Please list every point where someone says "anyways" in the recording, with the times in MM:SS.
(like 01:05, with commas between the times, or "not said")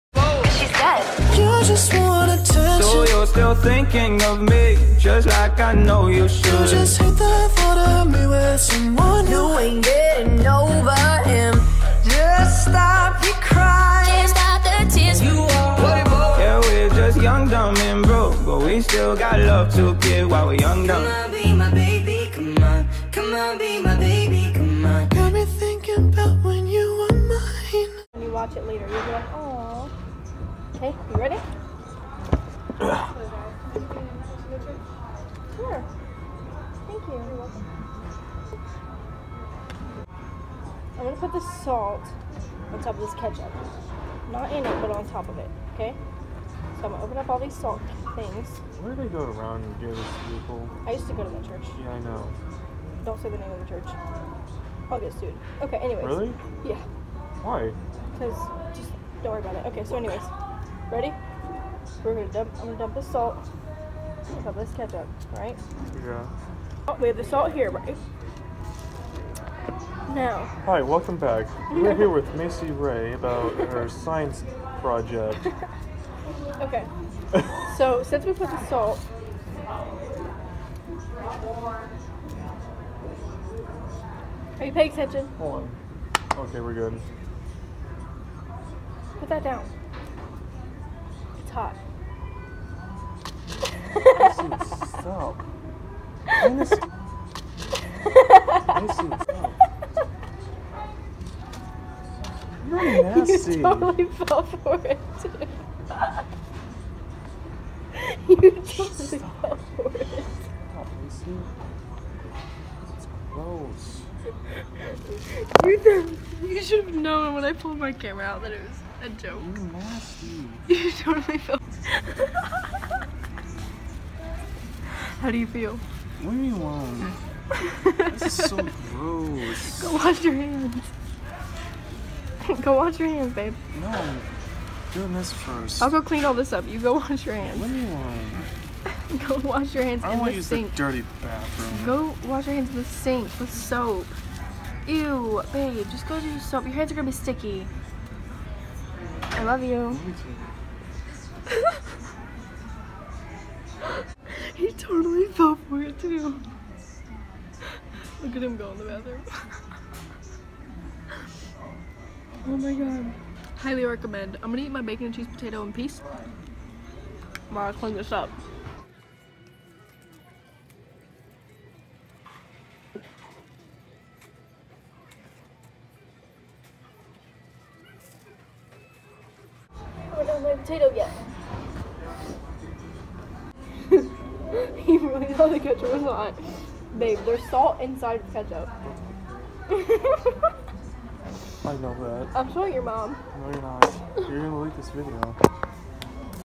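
00:55, 00:59.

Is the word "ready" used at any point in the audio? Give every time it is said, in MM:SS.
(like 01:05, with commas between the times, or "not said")
00:31, 01:00.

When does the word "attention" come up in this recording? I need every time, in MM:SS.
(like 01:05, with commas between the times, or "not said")
01:24.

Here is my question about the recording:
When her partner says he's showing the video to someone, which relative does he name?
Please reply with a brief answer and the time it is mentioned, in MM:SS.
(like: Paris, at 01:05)
your mom, at 03:12.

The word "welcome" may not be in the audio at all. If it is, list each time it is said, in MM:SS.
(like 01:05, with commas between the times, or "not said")
00:37, 01:10.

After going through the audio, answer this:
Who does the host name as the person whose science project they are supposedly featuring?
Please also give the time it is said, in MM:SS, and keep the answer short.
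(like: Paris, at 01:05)
Maycee Raye, at 01:12.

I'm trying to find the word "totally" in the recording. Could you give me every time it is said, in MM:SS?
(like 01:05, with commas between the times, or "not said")
01:42, 01:48, 02:00, 02:34.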